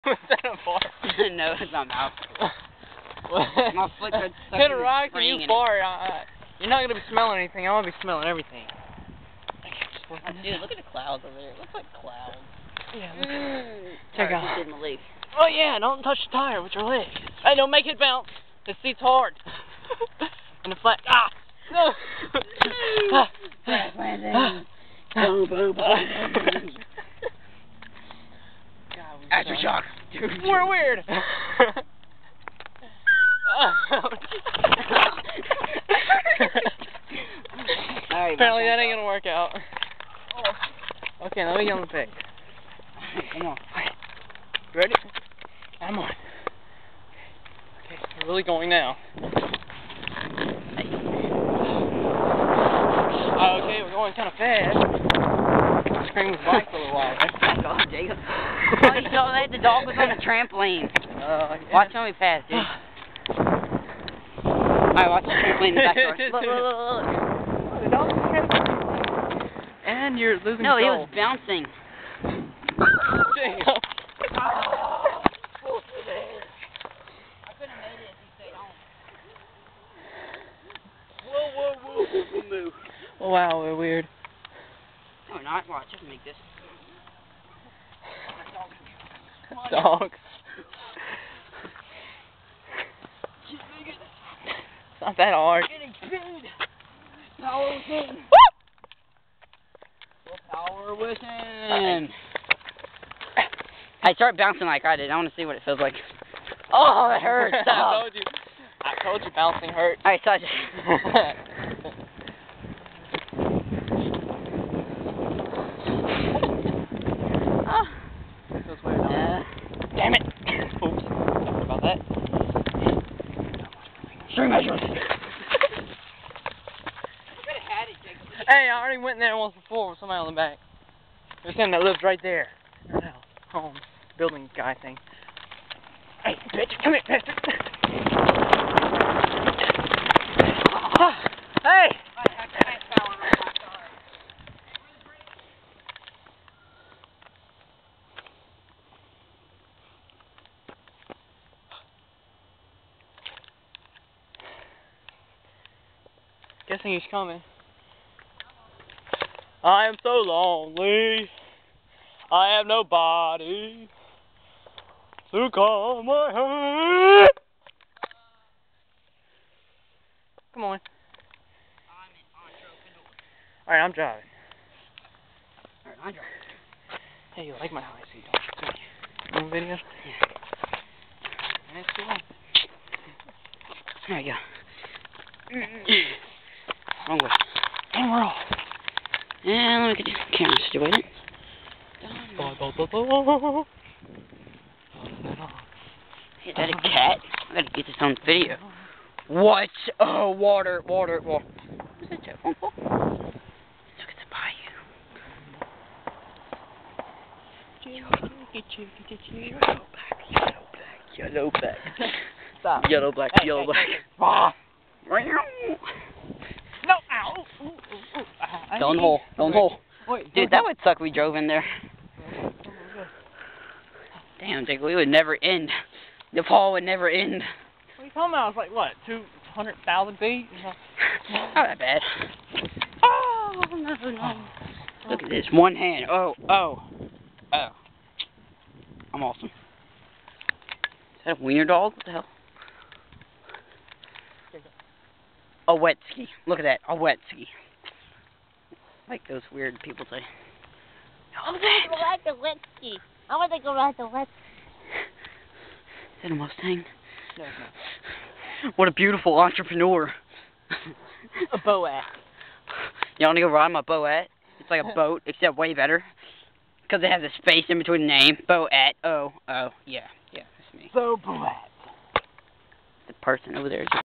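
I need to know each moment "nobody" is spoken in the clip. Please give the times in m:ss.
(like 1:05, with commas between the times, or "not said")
2:42.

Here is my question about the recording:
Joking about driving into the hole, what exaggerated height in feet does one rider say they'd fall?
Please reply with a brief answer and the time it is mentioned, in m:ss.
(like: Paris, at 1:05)
200,000 feet, at 3:49.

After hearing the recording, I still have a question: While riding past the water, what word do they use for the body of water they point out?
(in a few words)
bayou.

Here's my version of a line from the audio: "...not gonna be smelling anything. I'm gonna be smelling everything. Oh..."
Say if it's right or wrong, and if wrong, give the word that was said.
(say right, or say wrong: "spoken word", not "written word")
right.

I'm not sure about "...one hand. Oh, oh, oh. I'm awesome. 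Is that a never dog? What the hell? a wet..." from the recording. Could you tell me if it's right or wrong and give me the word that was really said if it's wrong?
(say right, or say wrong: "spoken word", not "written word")
wrong: "wiener", not "never".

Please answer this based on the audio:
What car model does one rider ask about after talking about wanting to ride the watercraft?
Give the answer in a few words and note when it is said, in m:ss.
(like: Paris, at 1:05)
Mustang, at 4:16.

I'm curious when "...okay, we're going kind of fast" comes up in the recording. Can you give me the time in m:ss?
0:53.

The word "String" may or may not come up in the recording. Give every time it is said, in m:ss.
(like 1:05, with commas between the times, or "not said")
2:04.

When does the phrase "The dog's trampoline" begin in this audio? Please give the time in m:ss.
1:07.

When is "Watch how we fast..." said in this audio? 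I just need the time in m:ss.
1:01.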